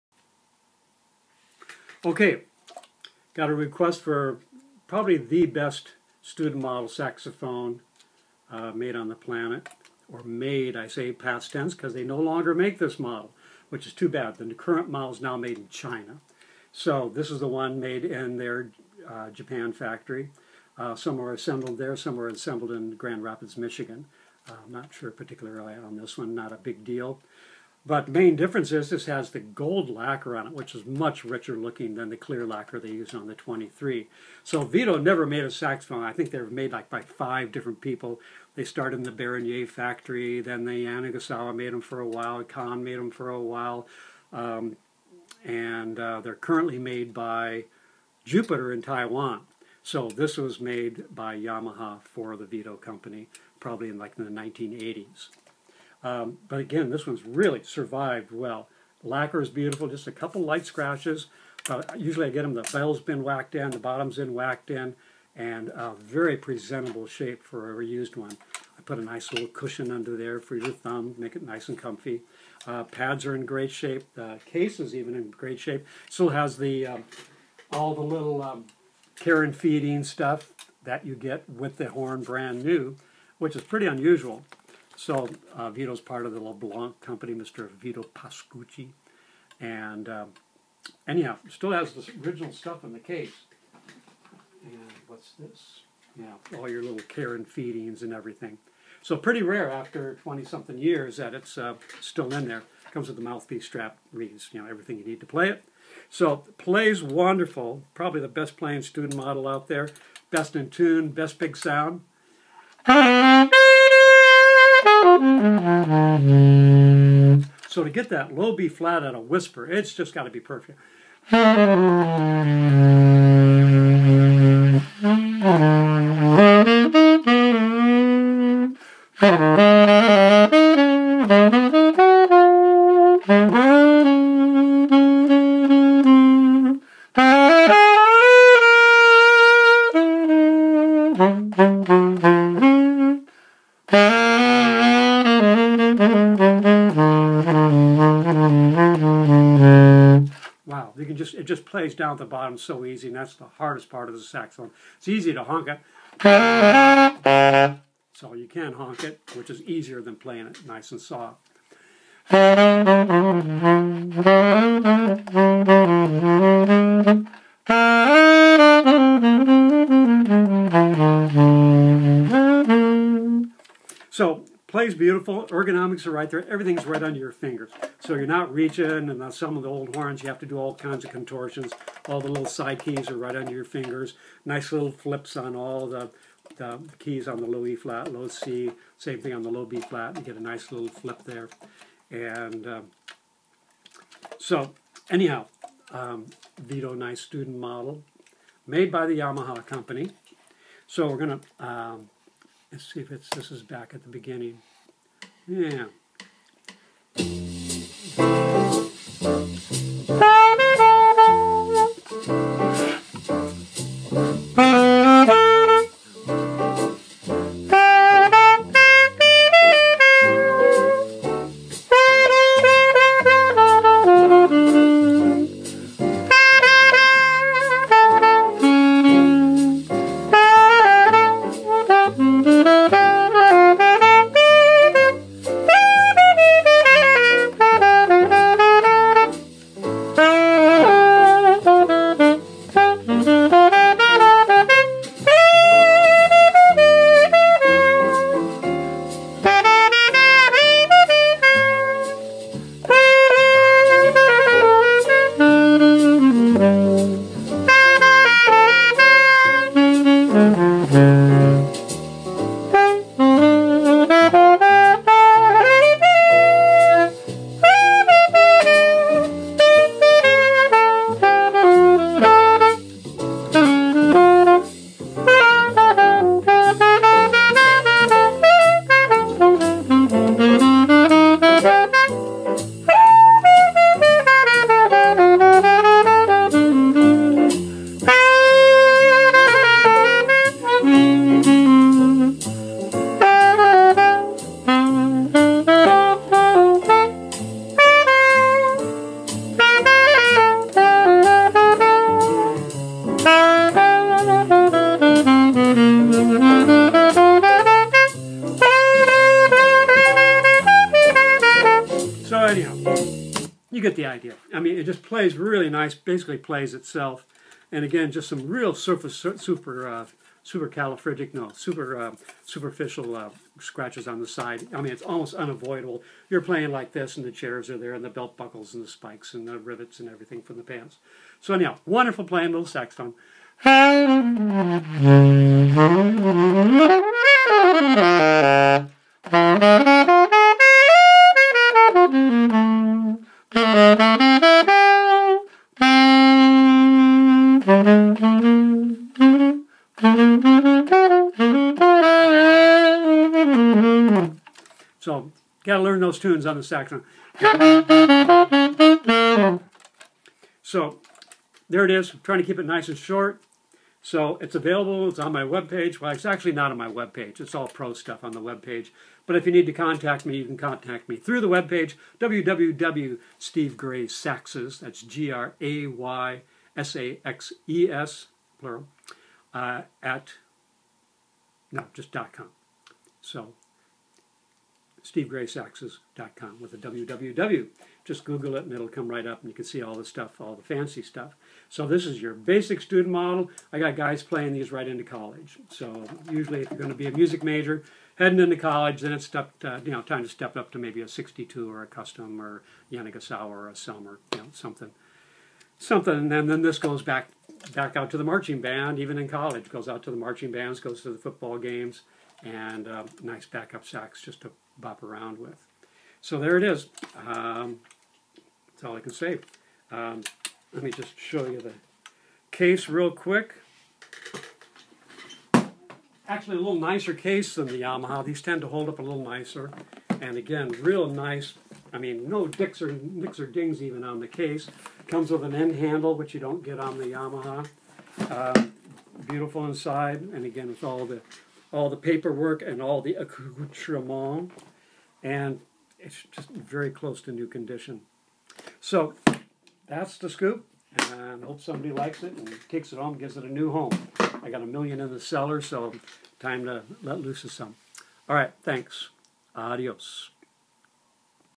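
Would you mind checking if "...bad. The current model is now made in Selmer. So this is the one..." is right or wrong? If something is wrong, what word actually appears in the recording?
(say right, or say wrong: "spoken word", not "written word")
wrong: "China", not "Selmer".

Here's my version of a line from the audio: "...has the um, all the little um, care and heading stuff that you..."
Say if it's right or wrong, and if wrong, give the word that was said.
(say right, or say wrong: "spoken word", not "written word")
wrong: "feeding", not "heading".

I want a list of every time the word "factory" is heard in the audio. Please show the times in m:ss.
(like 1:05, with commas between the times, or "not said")
0:19, 0:39.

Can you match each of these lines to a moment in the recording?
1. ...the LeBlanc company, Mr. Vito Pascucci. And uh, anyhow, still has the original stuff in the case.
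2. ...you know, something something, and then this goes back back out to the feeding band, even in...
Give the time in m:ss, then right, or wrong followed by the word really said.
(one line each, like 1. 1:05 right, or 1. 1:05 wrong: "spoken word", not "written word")
1. 1:26 right
2. 6:44 wrong: "marching", not "feeding".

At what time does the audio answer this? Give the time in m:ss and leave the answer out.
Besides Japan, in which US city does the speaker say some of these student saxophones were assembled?
0:22.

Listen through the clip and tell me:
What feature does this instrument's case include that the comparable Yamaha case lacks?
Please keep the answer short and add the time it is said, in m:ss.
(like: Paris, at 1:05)
An end handle, at 7:15.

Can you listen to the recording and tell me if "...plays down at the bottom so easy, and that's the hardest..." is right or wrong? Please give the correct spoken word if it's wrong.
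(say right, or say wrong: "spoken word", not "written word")
right.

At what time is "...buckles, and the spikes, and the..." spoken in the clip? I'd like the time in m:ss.
5:28.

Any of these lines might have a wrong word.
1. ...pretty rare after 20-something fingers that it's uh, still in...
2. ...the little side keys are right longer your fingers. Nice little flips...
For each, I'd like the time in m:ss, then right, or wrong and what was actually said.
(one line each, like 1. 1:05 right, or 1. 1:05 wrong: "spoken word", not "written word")
1. 1:39 wrong: "years", not "fingers"
2. 3:02 wrong: "under", not "longer".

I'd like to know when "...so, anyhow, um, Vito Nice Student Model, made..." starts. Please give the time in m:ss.
3:14.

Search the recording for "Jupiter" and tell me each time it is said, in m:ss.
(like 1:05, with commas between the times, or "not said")
0:48.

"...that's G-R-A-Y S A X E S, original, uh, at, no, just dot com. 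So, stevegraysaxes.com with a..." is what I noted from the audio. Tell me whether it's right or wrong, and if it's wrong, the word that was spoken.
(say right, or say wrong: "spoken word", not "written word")
wrong: "plural", not "original".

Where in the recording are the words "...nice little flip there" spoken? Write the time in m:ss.
3:10.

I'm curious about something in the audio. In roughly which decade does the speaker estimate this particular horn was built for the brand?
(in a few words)
1980s.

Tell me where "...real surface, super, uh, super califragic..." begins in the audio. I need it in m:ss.
5:18.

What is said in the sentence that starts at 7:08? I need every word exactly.
These tend to hold up a little nicer.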